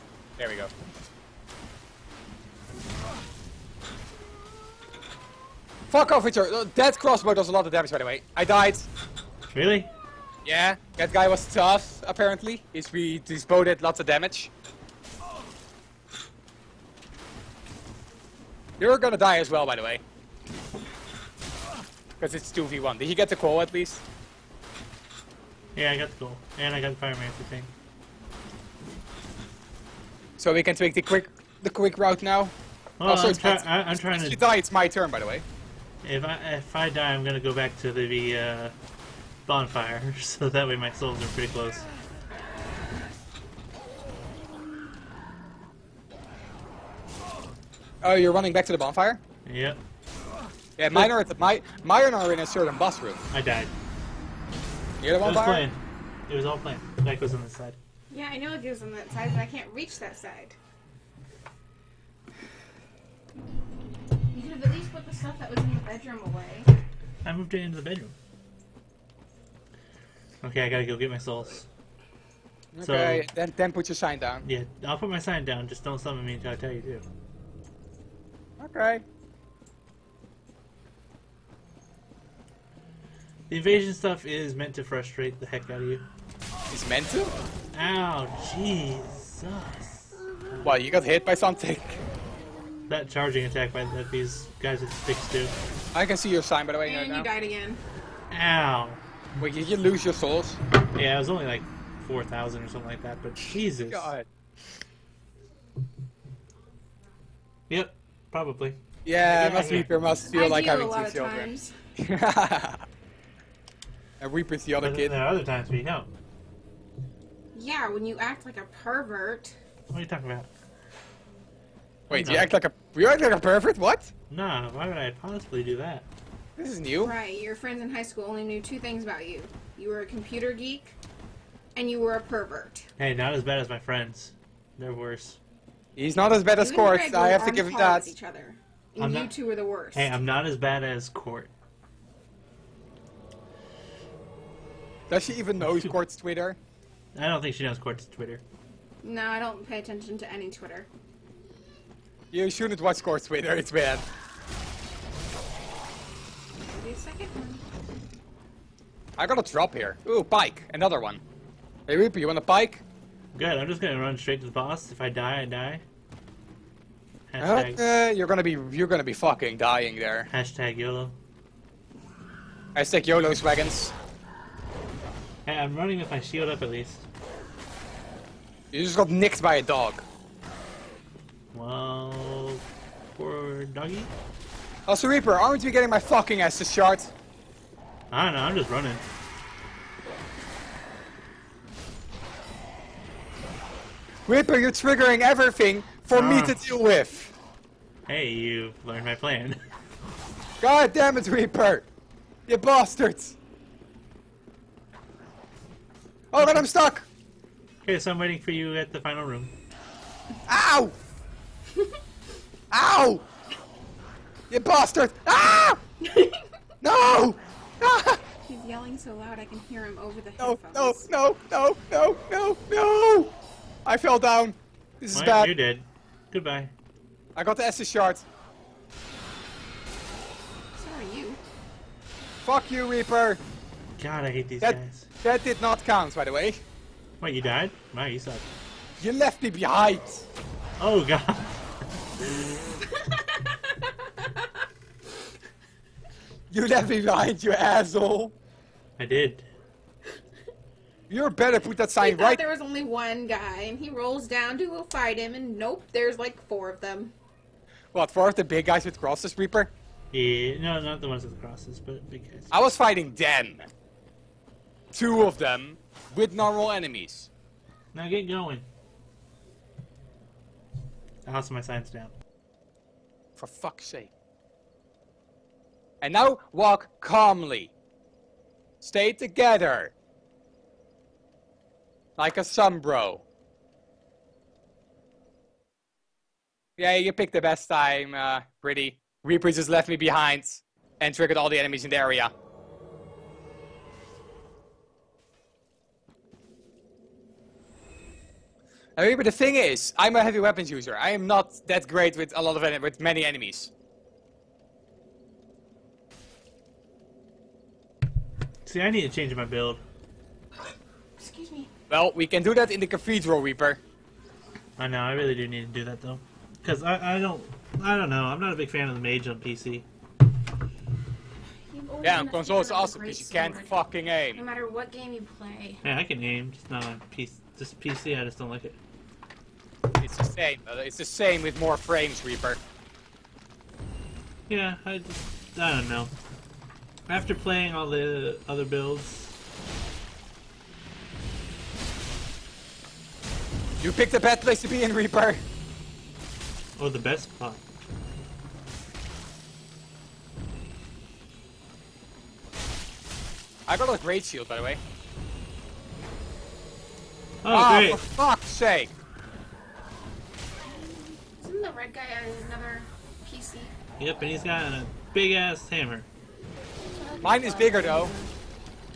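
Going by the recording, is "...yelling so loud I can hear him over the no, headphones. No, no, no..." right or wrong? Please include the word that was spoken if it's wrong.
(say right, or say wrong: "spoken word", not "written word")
right.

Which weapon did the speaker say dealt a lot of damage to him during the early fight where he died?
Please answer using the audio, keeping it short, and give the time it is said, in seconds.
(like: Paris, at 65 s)
Crossbow, at 6 s.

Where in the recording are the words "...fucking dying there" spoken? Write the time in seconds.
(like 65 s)
169 s.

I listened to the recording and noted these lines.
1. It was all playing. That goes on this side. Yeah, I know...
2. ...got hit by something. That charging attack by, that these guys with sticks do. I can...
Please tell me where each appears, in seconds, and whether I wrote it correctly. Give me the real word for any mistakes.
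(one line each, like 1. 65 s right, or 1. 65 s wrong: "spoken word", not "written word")
1. 56 s right
2. 90 s right.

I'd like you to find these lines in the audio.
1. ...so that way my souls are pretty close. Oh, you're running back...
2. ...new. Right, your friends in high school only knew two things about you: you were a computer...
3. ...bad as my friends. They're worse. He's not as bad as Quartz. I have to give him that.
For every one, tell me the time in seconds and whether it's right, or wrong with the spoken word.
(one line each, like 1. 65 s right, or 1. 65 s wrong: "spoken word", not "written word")
1. 40 s right
2. 126 s right
3. 133 s wrong: "Court", not "Quartz".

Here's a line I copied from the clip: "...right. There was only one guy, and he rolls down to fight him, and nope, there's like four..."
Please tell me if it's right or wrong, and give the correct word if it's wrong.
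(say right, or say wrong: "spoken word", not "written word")
right.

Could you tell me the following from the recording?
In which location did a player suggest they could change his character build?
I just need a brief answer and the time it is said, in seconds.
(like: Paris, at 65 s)
The Cathedral, at 312 s.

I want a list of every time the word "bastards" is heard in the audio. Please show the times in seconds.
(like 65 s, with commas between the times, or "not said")
202 s, 214 s.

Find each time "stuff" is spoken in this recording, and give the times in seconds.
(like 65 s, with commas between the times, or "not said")
65 s, 83 s.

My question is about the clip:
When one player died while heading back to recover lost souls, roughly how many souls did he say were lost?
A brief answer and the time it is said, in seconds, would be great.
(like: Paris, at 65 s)
4,000, at 102 s.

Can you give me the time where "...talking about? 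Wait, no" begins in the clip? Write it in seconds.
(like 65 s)
120 s.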